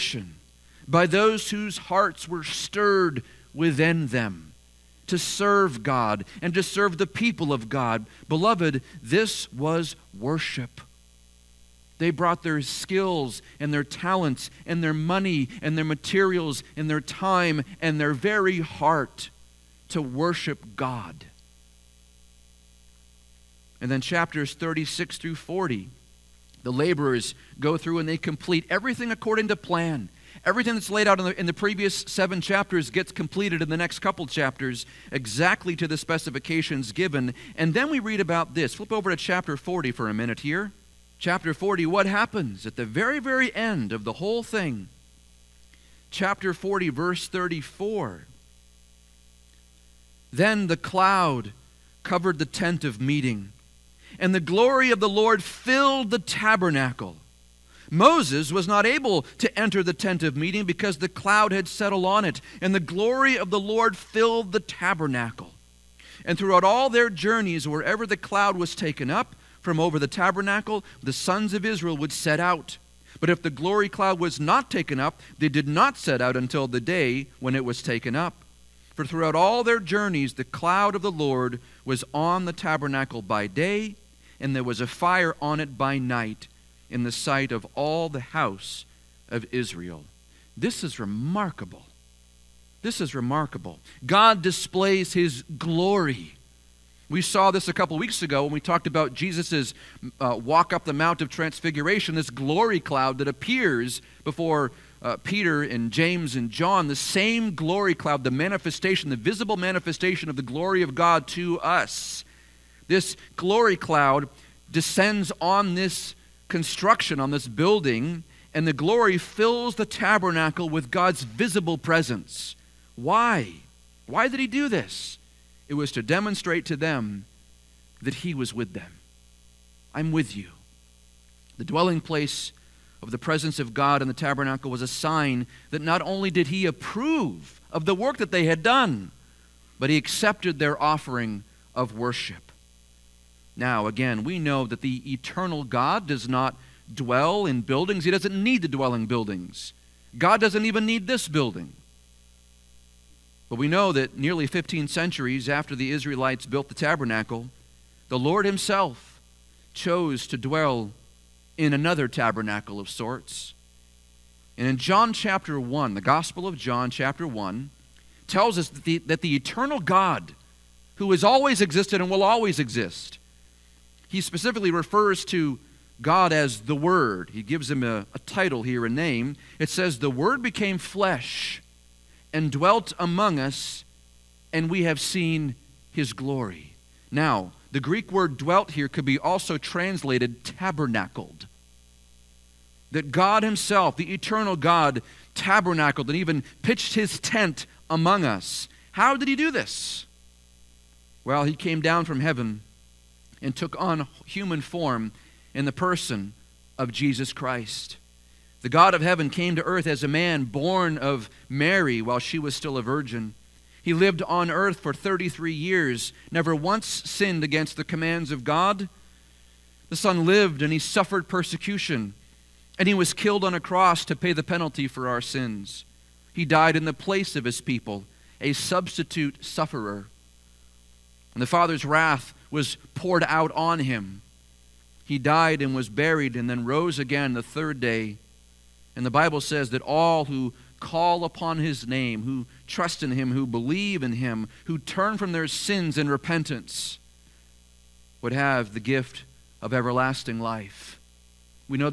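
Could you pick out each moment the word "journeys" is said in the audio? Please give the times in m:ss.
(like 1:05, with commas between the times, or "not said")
1:07, 1:19.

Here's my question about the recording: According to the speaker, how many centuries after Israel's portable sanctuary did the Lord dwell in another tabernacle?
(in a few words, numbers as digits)
15.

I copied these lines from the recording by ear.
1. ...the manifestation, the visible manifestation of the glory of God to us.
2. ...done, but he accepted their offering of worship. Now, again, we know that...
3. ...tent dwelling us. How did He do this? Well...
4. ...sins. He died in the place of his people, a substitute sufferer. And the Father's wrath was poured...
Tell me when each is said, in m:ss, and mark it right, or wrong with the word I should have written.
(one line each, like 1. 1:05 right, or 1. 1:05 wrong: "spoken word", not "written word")
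1. 1:48 right
2. 2:18 right
3. 3:17 wrong: "among", not "dwelling"
4. 3:45 right.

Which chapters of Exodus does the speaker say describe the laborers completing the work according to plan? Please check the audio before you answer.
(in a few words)
36 through 40.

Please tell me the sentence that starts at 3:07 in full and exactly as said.
Now, the Greek word dwelt here could be also translated tabernacled.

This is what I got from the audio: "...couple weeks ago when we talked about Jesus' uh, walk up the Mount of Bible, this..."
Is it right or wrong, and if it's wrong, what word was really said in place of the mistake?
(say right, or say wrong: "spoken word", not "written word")
wrong: "Transfiguration", not "Bible".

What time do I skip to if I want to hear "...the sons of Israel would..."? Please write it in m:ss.
1:11.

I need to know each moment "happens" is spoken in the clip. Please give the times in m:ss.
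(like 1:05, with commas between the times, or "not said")
0:42.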